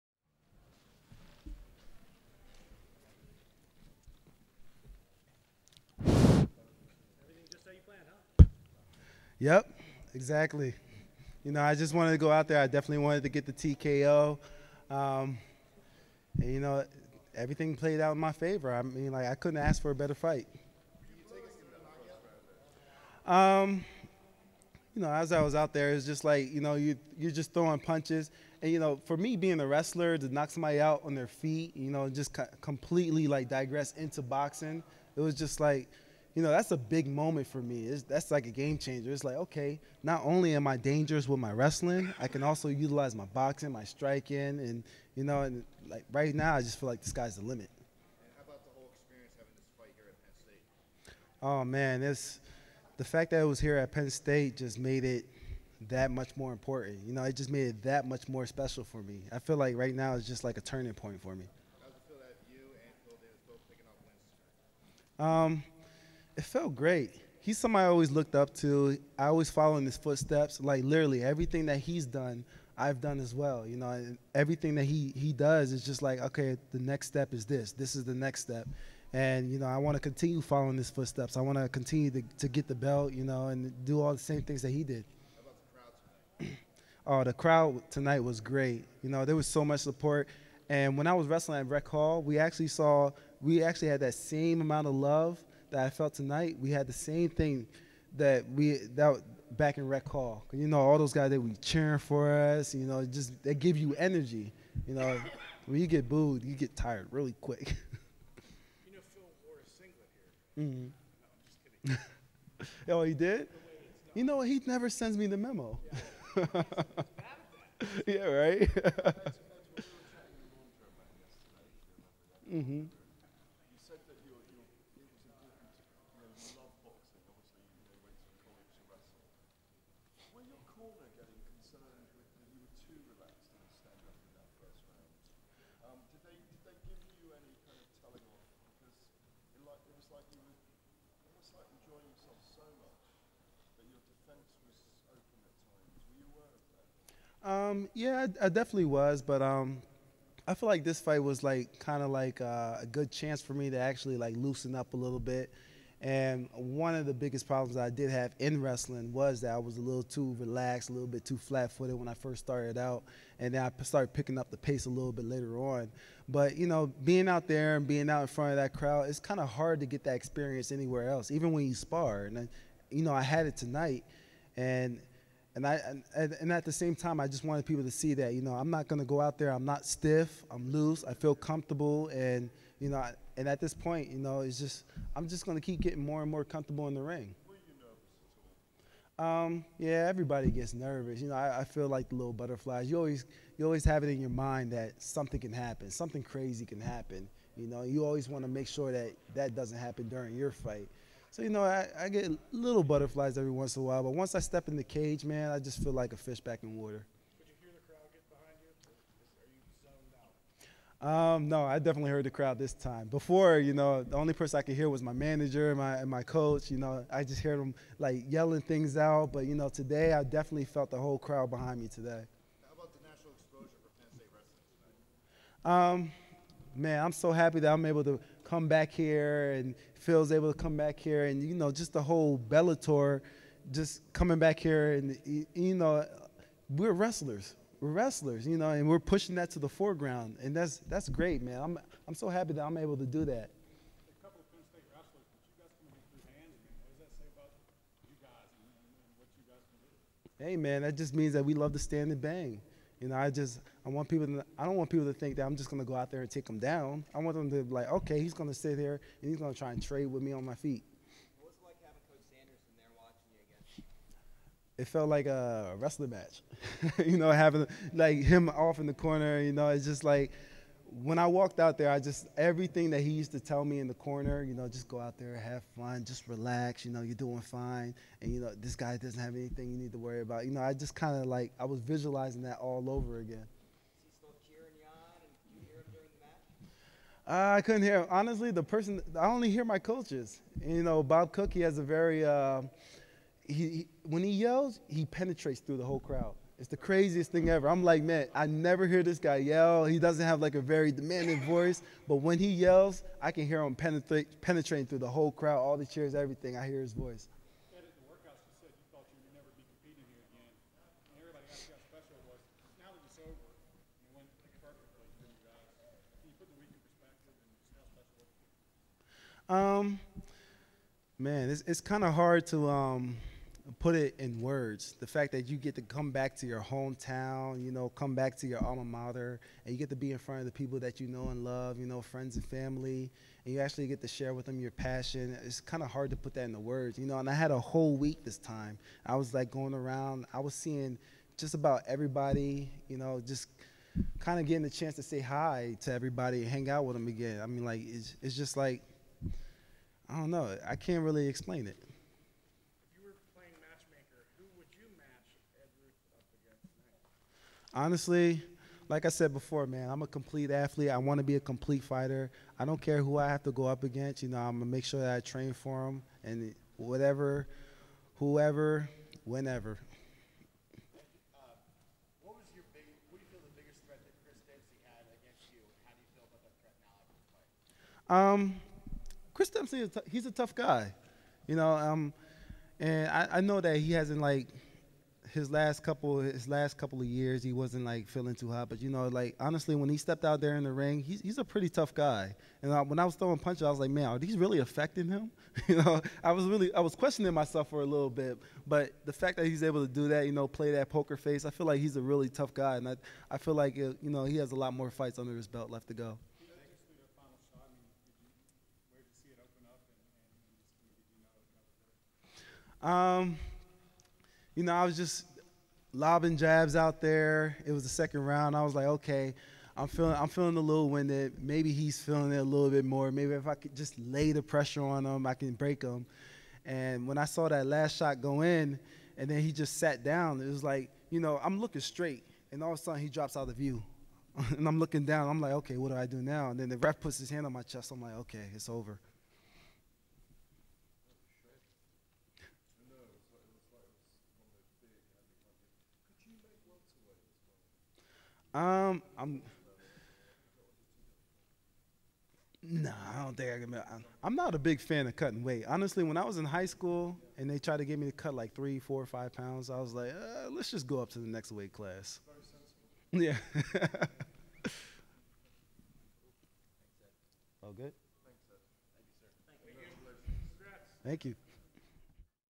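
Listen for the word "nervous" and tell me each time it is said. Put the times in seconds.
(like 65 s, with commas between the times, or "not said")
190 s.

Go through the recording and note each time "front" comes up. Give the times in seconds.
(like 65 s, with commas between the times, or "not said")
168 s, 330 s.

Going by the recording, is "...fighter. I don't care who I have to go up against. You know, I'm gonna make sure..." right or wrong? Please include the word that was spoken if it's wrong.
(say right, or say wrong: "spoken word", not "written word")
right.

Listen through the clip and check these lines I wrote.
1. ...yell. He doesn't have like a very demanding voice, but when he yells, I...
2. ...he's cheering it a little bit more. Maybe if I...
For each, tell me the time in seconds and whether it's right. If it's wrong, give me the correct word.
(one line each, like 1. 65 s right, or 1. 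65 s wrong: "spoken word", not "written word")
1. 299 s right
2. 421 s wrong: "feeling", not "cheering".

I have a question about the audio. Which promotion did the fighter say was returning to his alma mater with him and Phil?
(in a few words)
Bellator.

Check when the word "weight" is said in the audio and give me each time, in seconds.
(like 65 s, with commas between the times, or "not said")
455 s, 461 s.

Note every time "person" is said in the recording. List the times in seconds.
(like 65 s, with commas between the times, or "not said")
214 s, 288 s.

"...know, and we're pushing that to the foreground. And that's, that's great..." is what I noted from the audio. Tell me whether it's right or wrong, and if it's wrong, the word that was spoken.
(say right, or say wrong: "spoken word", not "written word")
right.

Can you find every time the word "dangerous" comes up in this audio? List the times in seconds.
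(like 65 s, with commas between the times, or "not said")
40 s.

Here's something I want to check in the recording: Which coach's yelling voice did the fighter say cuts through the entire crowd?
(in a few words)
Bob Cook.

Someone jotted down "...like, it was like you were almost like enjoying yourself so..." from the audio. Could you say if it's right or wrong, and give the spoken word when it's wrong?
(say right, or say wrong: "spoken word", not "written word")
right.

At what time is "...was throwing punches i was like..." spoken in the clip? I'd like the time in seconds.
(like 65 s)
393 s.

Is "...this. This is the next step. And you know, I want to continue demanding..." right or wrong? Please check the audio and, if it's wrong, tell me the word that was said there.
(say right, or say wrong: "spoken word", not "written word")
wrong: "following", not "demanding".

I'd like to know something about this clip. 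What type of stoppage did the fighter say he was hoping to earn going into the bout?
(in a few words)
TKO.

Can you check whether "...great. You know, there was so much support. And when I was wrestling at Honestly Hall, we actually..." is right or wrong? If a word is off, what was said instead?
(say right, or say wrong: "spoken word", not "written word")
wrong: "Rec", not "Honestly".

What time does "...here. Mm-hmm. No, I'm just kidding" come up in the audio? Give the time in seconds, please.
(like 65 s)
110 s.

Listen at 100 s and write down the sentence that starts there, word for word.
You know, all those guys that we cheering for us.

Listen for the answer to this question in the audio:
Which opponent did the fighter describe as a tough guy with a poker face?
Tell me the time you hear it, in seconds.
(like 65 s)
379 s.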